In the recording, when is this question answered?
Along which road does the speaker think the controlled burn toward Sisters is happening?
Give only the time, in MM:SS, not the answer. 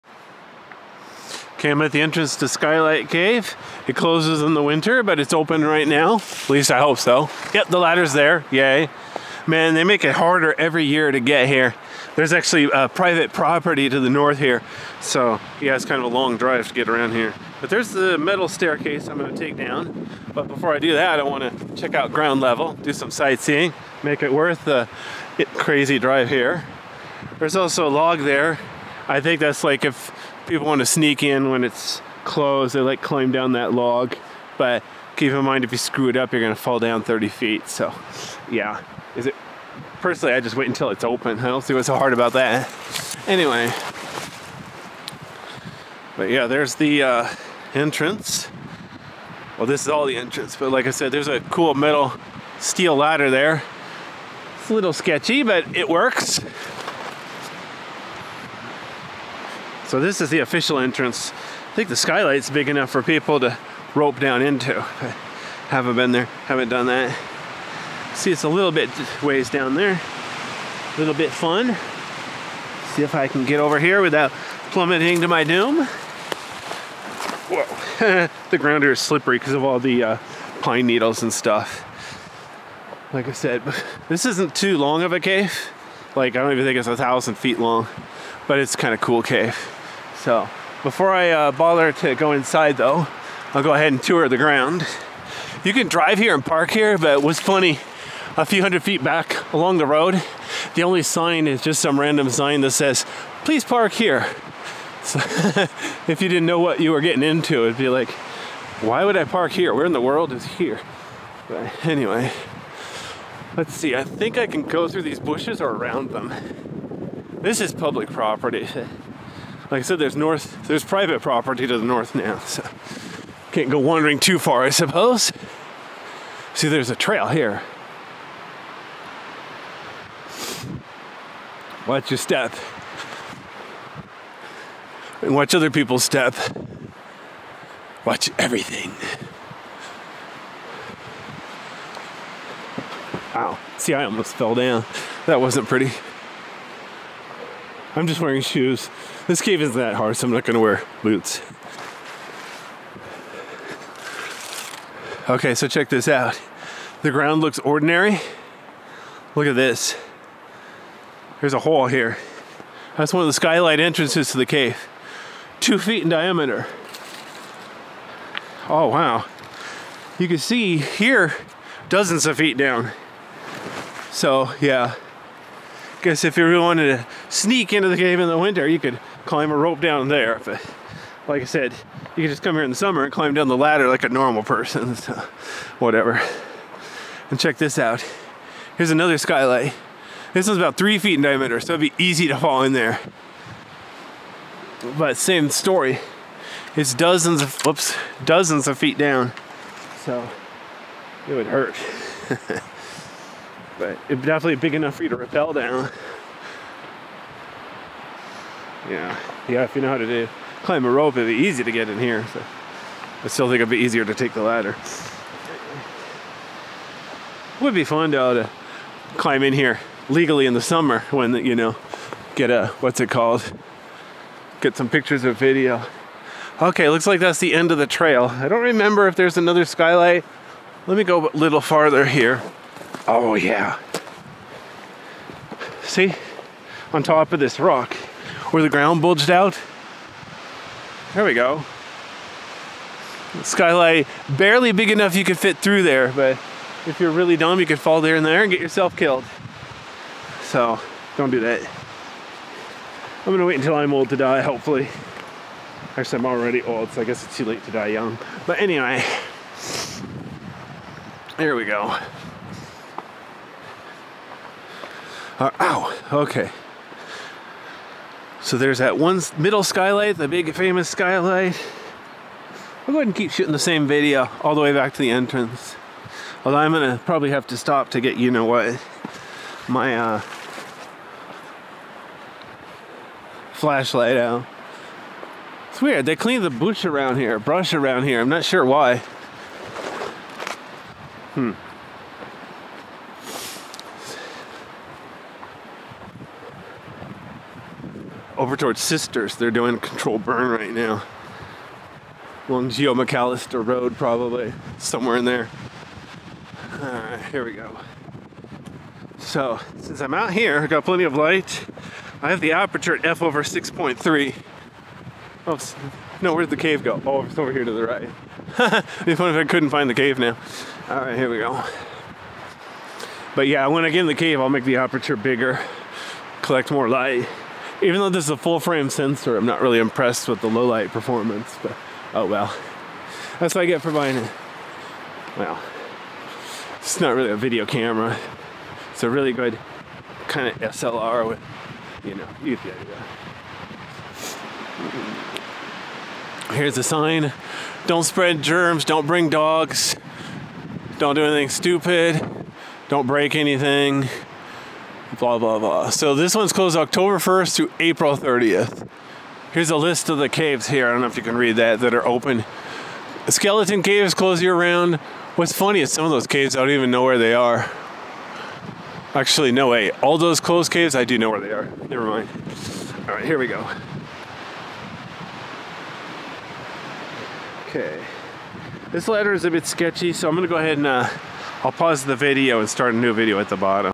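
05:02.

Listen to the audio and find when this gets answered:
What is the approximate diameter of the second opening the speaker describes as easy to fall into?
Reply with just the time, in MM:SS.
03:10.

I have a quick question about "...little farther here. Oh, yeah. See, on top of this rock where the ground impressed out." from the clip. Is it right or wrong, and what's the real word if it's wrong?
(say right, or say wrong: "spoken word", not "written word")
wrong: "bulged", not "impressed".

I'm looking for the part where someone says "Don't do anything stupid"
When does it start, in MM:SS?
05:50.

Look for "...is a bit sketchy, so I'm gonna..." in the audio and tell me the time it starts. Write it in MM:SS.
06:19.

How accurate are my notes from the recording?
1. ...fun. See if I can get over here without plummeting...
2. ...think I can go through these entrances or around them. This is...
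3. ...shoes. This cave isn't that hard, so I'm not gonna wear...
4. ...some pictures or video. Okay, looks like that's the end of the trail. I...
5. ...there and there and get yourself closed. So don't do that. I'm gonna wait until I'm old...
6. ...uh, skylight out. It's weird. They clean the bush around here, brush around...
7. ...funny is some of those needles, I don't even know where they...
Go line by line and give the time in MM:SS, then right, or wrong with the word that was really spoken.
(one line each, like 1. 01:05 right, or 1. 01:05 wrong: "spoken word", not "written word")
1. 01:11 right
2. 01:54 wrong: "bushes", not "entrances"
3. 02:28 right
4. 03:44 right
5. 04:07 wrong: "killed", not "closed"
6. 04:39 wrong: "flashlight", not "skylight"
7. 06:05 wrong: "caves", not "needles".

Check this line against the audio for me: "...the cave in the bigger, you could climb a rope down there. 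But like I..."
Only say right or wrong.
wrong.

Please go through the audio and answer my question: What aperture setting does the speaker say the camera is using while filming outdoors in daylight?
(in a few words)
f/6.3.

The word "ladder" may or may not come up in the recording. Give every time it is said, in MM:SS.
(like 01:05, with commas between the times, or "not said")
00:07, 00:52, 03:03, 03:34, 06:19.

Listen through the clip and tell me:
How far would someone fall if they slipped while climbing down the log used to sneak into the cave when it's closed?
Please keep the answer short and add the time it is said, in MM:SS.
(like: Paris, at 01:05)
30 feet, at 00:37.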